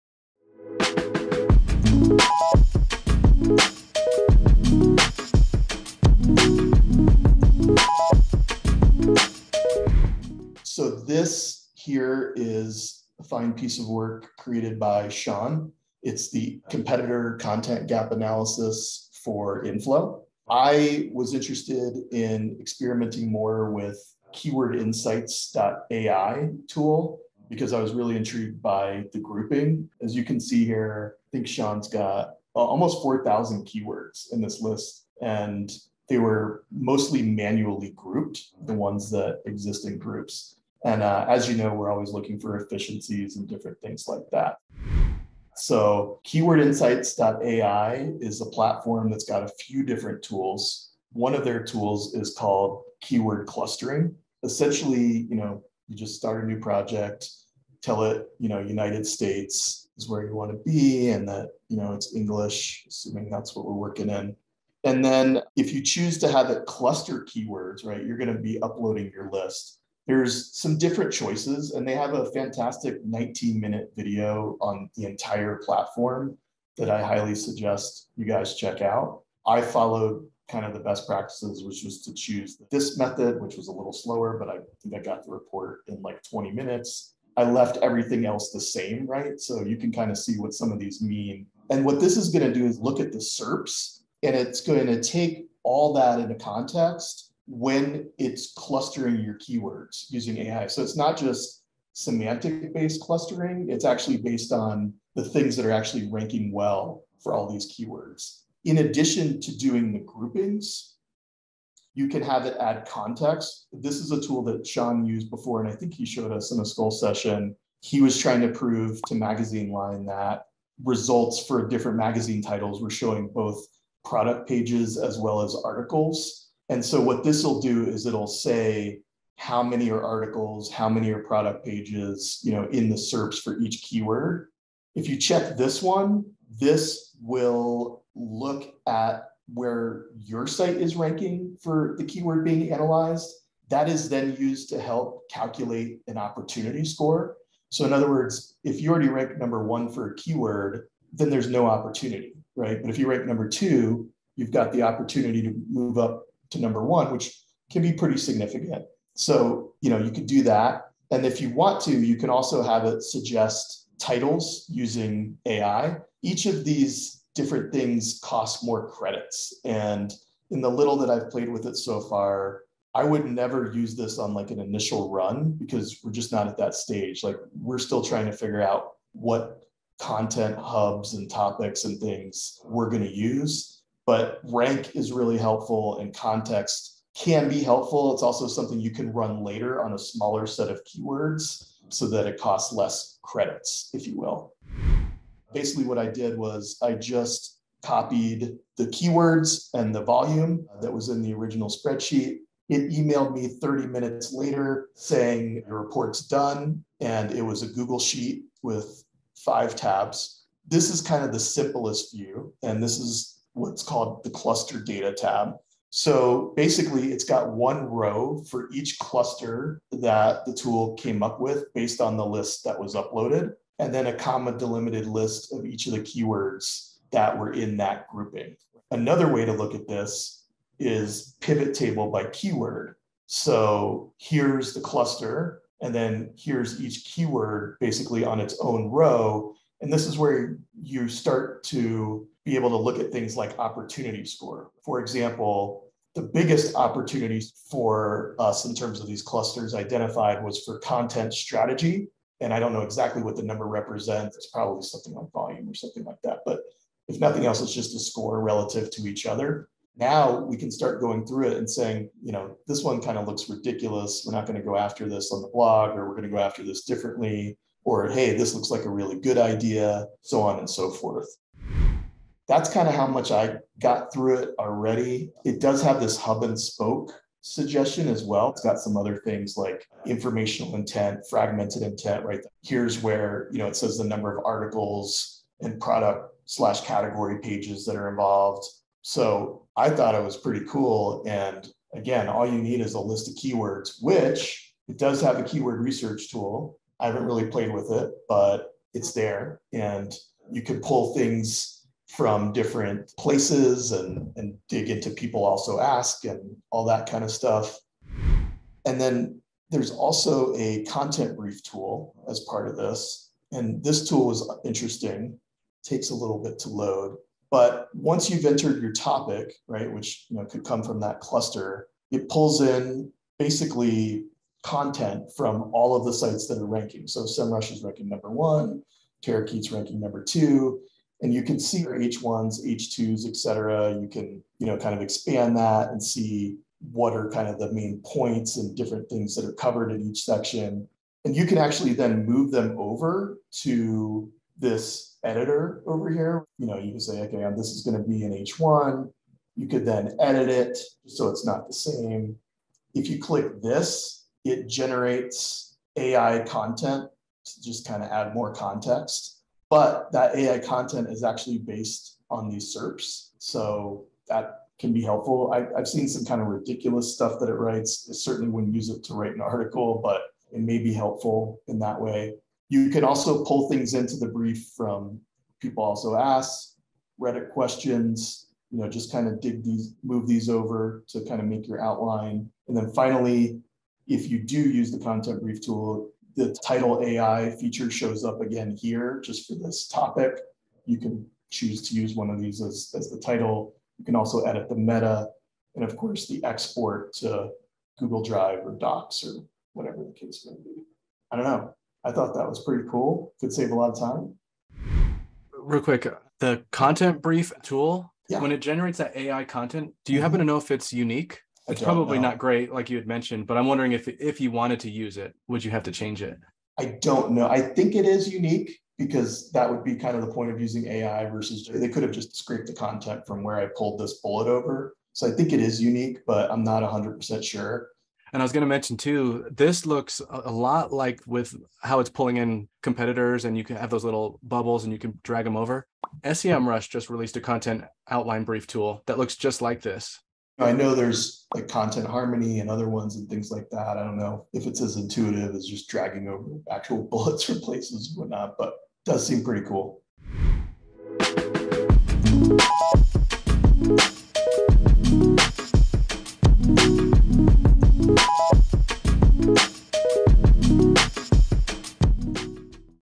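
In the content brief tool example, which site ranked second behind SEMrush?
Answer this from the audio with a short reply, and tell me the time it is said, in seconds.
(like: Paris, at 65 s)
Terakeet, at 329 s.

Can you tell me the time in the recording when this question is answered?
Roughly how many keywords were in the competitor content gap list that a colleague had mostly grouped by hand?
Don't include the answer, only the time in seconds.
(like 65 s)
33 s.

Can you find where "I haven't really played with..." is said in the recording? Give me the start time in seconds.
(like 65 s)
296 s.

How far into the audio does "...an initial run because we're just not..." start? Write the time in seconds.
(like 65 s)
174 s.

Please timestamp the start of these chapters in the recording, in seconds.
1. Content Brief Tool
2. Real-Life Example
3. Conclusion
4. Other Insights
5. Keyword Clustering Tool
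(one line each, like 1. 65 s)
1. 308 s
2. 195 s
3. 450 s
4. 272 s
5. 45 s.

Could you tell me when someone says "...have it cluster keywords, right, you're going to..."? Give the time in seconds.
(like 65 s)
66 s.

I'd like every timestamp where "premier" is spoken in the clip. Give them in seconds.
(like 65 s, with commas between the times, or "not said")
not said.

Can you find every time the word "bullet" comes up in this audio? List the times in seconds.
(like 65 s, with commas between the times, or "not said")
424 s, 447 s.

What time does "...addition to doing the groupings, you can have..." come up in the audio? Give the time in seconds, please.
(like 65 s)
108 s.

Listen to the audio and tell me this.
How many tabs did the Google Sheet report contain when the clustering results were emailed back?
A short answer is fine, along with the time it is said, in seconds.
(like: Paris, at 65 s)
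5, at 209 s.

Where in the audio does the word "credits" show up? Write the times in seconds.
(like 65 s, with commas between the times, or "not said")
168 s, 193 s.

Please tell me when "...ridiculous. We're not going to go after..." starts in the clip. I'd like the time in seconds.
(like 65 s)
263 s.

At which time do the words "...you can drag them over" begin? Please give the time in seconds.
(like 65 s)
434 s.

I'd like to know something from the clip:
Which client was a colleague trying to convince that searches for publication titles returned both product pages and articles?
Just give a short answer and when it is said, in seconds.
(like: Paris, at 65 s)
Magazine Line, at 119 s.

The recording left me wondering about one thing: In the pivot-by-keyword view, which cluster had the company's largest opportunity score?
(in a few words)
content strategy.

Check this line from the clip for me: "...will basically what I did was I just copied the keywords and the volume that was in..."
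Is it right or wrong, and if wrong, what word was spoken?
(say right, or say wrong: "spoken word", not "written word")
right.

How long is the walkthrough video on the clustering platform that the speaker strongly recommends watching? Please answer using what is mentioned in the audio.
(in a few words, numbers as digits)
19 minutes.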